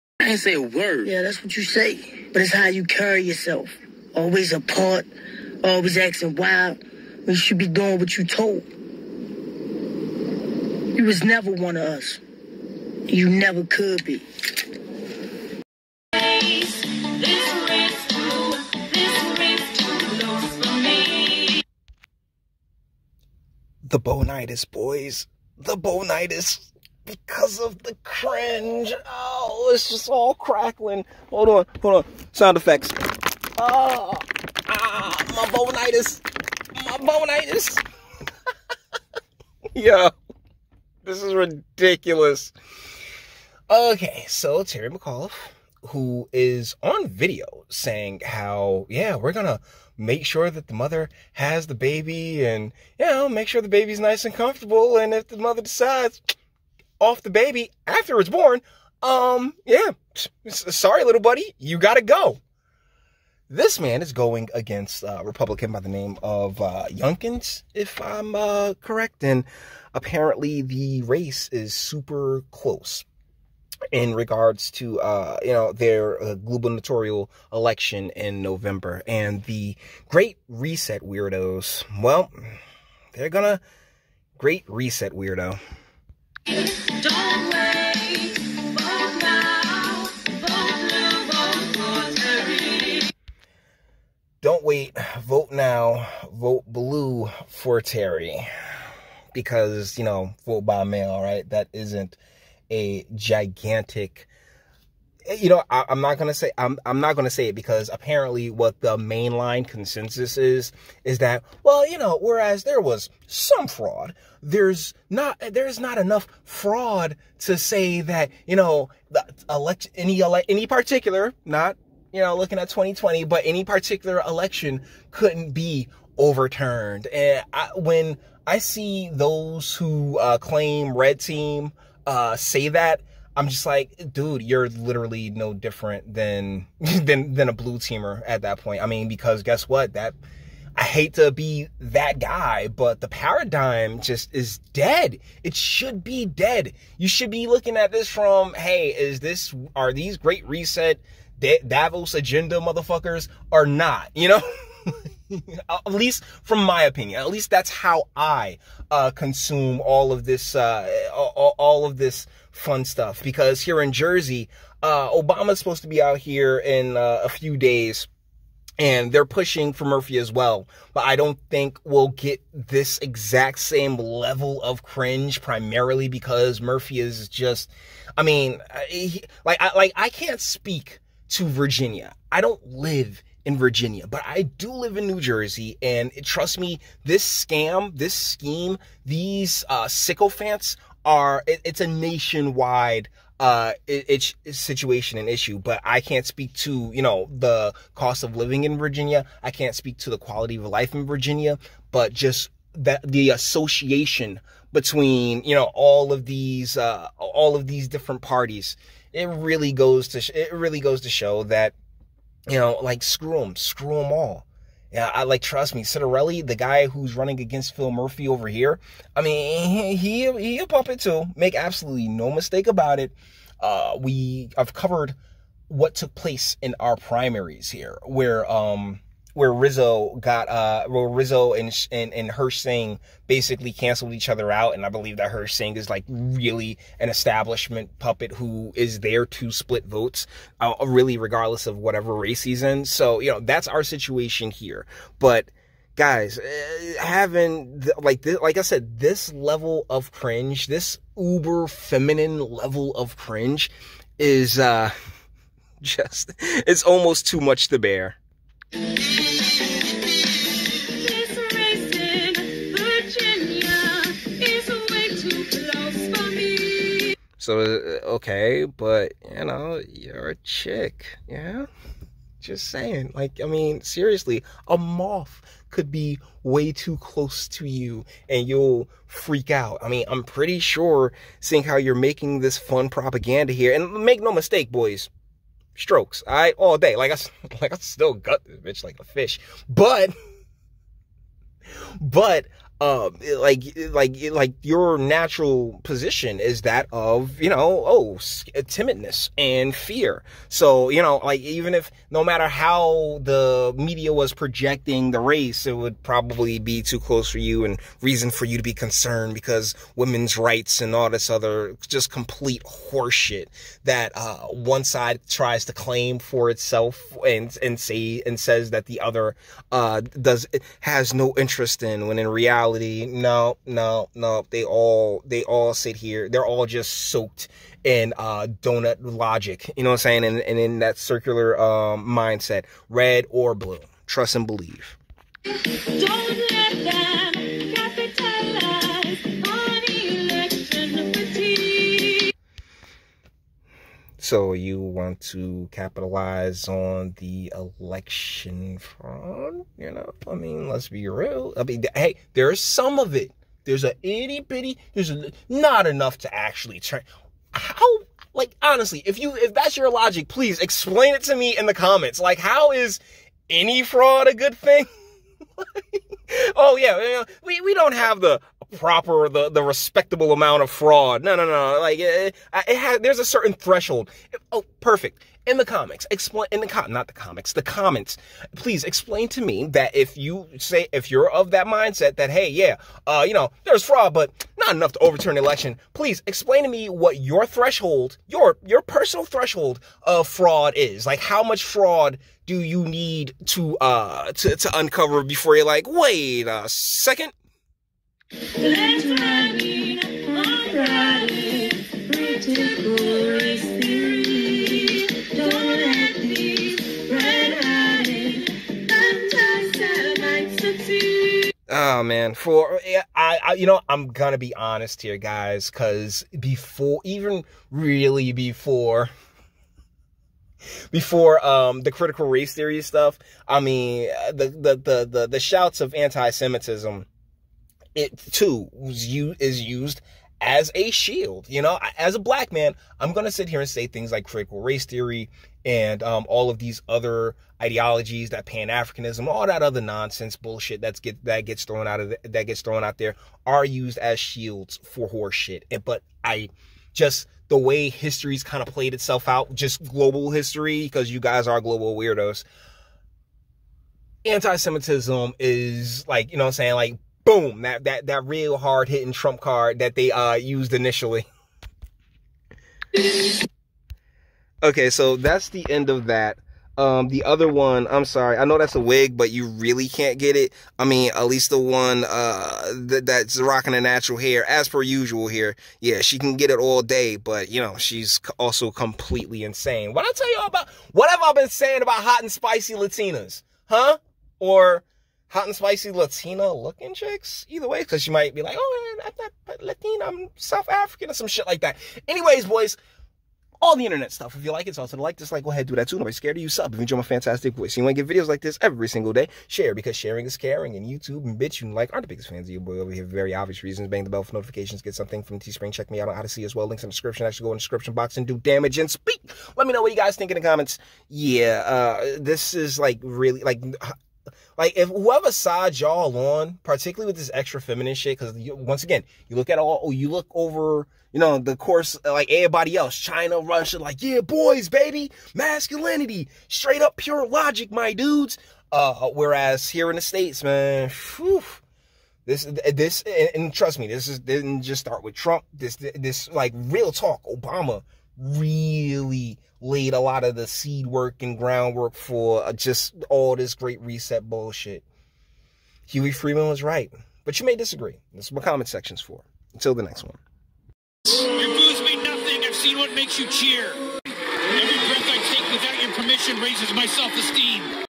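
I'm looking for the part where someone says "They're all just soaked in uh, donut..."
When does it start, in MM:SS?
05:26.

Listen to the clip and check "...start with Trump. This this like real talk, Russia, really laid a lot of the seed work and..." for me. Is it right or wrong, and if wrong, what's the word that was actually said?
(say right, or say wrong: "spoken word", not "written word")
wrong: "Obama", not "Russia".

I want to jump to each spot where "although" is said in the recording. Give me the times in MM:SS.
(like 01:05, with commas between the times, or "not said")
not said.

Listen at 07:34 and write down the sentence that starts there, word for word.
Anti-Semitism is like, you know I'm saying, like boom, that that that real hard hitting trump card that they uh used initially.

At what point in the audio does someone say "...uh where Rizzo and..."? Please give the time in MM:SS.
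03:50.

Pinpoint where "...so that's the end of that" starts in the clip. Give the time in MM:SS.
07:44.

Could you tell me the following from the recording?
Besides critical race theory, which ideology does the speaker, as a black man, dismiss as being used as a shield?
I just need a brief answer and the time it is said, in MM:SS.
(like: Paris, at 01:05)
Pan Africanism, at 07:18.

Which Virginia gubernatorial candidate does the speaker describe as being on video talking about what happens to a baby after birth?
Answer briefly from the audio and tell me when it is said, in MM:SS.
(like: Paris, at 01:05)
Terry McAuliffe, at 00:44.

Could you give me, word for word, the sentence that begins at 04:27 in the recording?
So, uh, okay, but, you know, you're a chick, yeah?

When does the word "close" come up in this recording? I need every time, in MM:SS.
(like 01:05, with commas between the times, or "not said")
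01:12, 04:36, 05:06.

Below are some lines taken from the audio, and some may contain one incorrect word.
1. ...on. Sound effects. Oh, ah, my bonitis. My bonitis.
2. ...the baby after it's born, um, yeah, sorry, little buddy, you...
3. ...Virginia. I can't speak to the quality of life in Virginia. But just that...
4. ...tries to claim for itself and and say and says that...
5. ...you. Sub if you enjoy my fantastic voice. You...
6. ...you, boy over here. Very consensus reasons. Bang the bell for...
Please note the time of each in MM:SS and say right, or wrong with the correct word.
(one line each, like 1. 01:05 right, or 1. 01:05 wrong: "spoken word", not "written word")
1. 00:31 right
2. 00:57 right
3. 03:18 right
4. 05:15 right
5. 08:16 right
6. 08:22 wrong: "obvious", not "consensus".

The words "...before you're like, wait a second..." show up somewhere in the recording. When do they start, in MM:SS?
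06:35.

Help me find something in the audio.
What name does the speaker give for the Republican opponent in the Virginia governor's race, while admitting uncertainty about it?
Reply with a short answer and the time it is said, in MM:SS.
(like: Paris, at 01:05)
Youngkins, at 01:06.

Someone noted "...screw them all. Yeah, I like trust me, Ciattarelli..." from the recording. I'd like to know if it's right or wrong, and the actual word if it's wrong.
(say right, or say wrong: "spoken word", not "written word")
right.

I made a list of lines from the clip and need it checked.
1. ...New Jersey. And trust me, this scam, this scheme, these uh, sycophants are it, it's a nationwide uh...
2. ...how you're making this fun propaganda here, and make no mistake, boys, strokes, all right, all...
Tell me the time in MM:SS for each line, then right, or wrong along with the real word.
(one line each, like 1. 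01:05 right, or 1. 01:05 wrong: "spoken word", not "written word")
1. 03:05 right
2. 04:41 right.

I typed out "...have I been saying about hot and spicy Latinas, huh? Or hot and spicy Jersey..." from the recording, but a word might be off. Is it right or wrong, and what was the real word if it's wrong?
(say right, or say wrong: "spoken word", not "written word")
wrong: "Latina", not "Jersey".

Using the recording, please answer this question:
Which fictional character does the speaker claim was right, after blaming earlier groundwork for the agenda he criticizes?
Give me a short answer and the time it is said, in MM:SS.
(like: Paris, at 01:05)
Huey Freeman, at 09:05.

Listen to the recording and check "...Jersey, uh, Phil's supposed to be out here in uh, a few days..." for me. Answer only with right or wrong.
wrong.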